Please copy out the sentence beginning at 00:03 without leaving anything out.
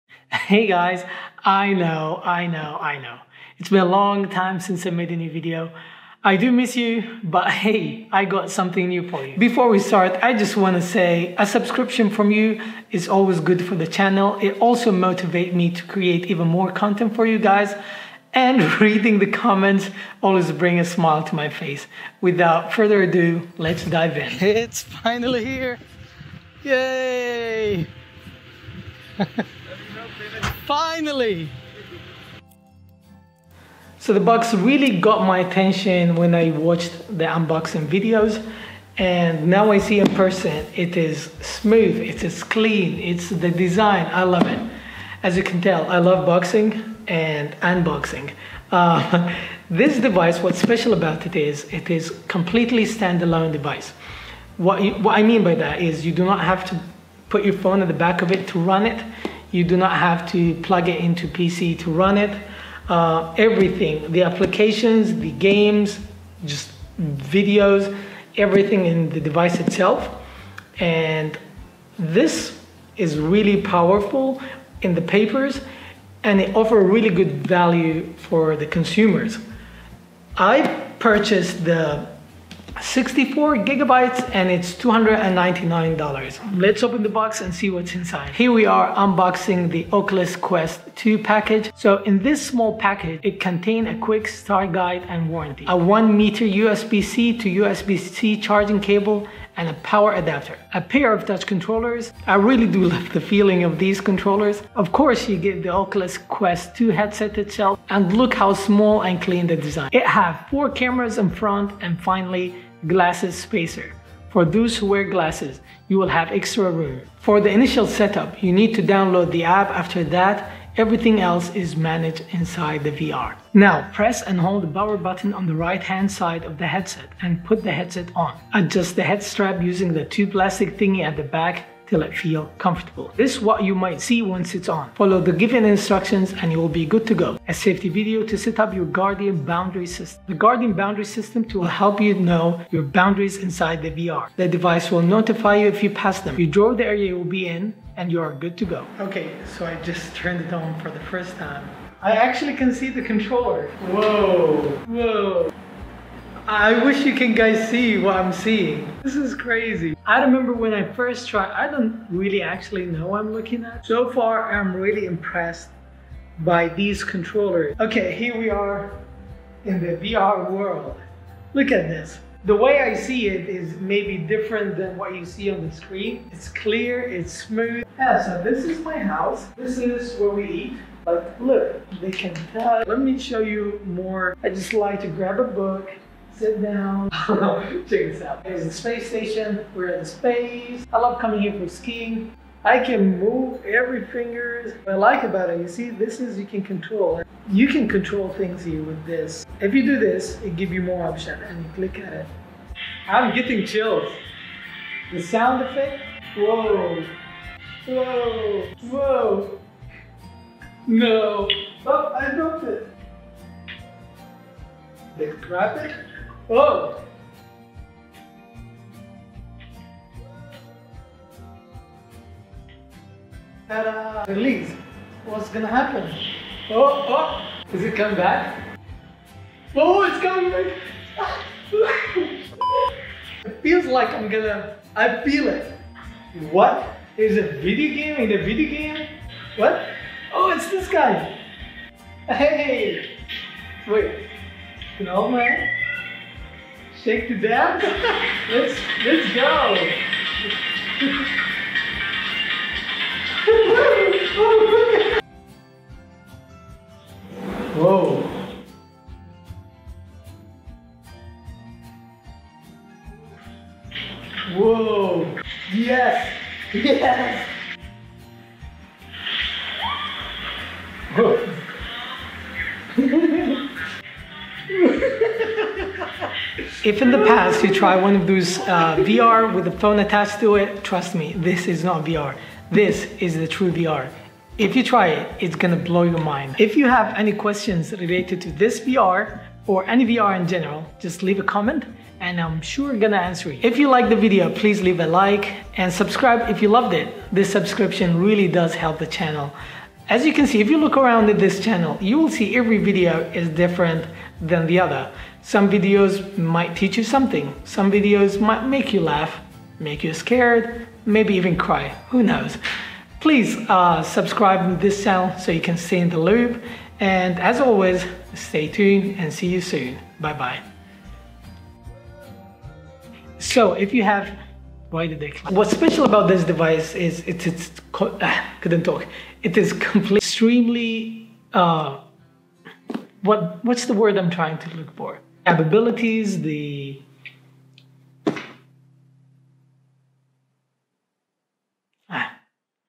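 It's been a long time since I made a new video.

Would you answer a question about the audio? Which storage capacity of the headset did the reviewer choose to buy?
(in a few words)
64 gigabytes.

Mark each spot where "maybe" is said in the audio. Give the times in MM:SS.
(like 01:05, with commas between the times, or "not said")
02:53, 05:11.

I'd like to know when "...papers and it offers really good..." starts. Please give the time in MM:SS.
01:15.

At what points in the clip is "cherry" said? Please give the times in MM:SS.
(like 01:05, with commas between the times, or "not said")
not said.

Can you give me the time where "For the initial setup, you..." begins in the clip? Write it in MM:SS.
01:57.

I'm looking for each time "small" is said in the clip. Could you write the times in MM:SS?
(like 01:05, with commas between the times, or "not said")
01:32, 01:48.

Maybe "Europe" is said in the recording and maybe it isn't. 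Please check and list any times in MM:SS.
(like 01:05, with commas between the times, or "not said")
not said.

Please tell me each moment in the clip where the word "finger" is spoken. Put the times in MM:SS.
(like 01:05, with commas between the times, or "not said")
03:14.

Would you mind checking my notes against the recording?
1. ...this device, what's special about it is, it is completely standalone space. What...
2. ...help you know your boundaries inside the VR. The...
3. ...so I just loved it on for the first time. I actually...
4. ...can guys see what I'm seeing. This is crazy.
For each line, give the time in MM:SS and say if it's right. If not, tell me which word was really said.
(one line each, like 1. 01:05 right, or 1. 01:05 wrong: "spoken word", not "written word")
1. 00:49 wrong: "device", not "space"
2. 02:21 right
3. 02:29 wrong: "turned", not "loved"
4. 02:37 right.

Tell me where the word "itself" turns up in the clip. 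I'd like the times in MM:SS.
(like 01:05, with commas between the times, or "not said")
01:09, 01:47.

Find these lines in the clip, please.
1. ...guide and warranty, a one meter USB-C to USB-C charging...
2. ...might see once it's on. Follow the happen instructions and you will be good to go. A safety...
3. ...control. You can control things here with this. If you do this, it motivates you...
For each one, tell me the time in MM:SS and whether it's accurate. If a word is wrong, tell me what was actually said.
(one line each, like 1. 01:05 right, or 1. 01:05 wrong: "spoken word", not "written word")
1. 01:34 right
2. 02:13 wrong: "given", not "happen"
3. 03:16 wrong: "gives", not "motivates".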